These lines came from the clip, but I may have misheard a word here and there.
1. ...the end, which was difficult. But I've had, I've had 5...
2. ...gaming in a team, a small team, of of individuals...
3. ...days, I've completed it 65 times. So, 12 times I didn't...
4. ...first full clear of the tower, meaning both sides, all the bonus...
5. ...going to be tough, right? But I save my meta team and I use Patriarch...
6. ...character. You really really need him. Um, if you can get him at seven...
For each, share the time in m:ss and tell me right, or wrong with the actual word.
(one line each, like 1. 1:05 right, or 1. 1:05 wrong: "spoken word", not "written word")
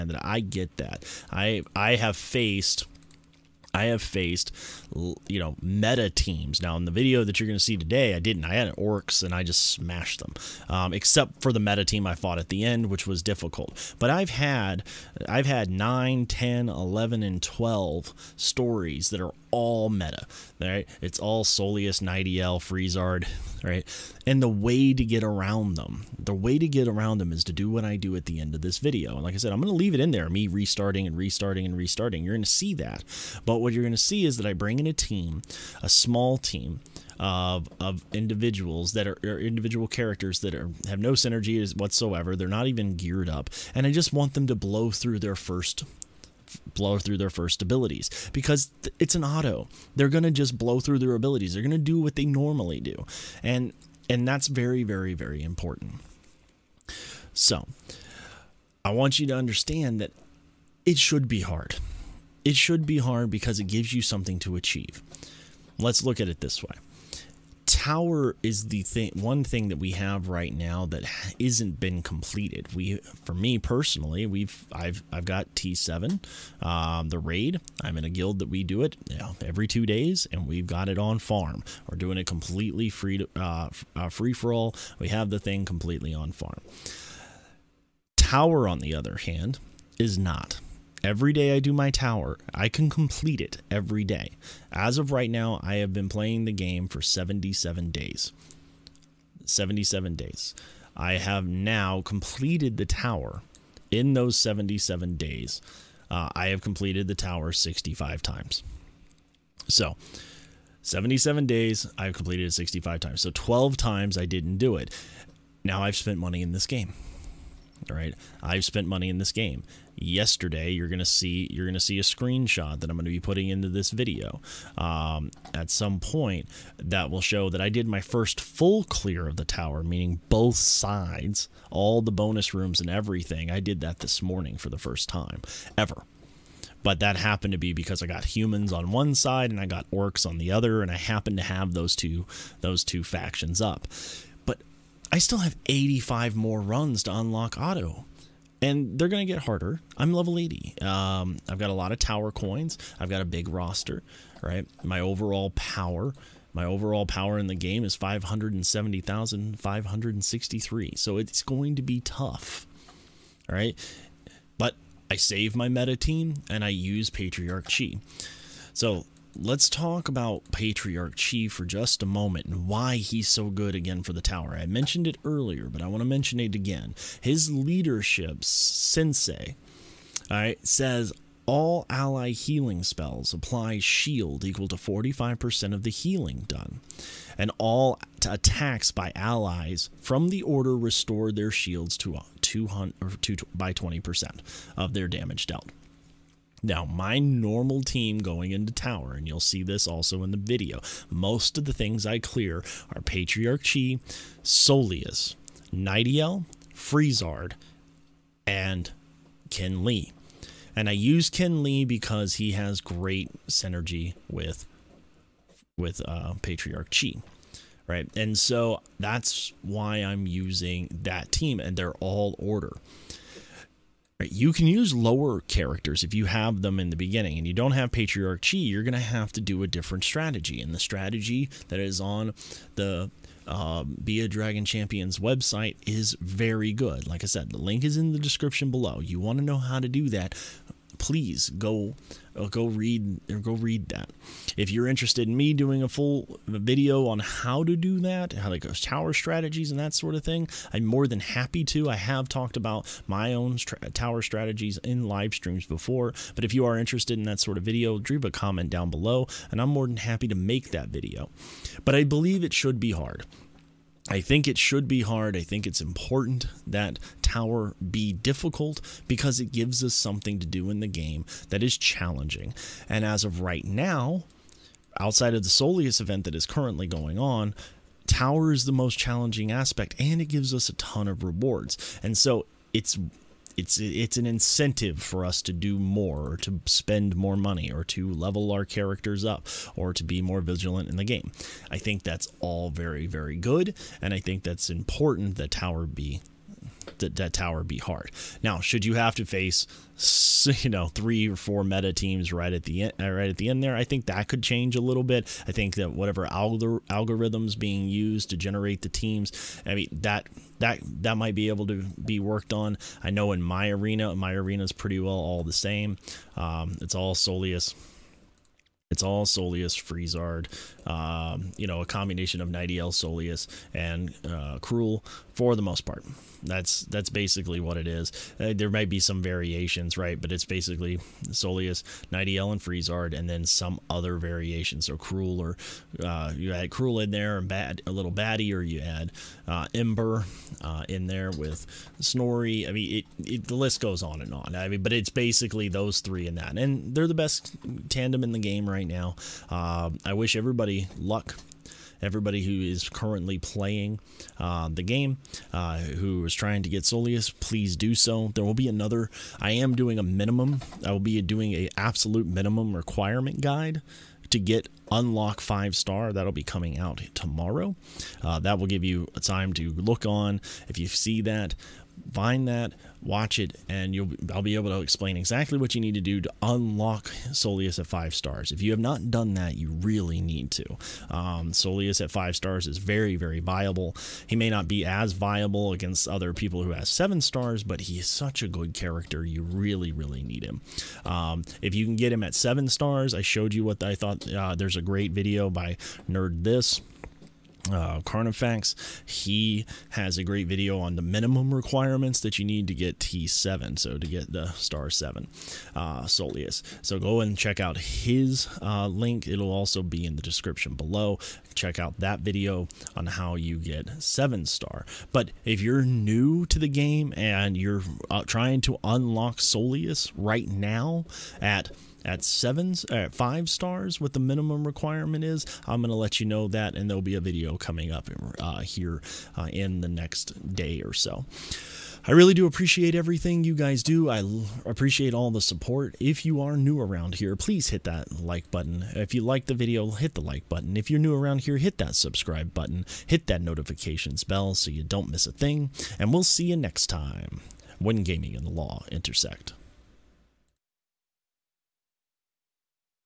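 1. 0:12 wrong: "9", not "5"
2. 0:34 wrong: "bring", not "gaming"
3. 1:51 right
4. 2:07 right
5. 2:41 right
6. 6:28 right.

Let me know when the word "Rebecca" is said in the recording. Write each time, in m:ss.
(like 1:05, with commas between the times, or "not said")
not said.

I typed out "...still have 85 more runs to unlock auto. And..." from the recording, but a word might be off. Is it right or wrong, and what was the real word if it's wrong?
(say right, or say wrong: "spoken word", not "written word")
right.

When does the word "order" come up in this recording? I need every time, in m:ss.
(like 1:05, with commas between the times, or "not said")
3:10, 3:42.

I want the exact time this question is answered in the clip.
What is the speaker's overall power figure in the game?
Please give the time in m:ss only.
2:37.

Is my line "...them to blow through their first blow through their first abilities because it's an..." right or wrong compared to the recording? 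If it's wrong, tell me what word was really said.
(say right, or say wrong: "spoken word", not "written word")
right.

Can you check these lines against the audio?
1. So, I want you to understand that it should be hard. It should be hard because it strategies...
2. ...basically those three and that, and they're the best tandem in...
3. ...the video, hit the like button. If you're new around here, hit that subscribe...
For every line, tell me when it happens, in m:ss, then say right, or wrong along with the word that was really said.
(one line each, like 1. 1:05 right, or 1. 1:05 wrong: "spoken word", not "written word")
1. 0:57 wrong: "gives", not "strategies"
2. 5:45 right
3. 7:19 right.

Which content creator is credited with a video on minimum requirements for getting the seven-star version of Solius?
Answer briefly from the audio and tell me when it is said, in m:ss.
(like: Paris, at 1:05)
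Carnifax, at 6:38.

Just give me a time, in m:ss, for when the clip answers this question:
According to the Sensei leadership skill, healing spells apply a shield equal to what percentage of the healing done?
3:04.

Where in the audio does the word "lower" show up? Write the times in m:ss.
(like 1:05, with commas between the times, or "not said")
3:44.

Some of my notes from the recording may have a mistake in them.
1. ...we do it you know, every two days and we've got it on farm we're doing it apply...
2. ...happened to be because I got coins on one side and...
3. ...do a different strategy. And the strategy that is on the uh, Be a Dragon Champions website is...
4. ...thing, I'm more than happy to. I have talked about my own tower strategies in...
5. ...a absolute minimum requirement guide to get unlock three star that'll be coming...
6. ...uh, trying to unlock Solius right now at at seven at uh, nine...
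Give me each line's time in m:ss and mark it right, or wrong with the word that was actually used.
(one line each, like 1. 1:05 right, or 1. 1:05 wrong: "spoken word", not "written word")
1. 1:18 wrong: "completely", not "apply"
2. 2:17 wrong: "humans", not "coins"
3. 3:49 right
4. 4:10 right
5. 6:01 wrong: "five", not "three"
6. 6:58 wrong: "five", not "nine".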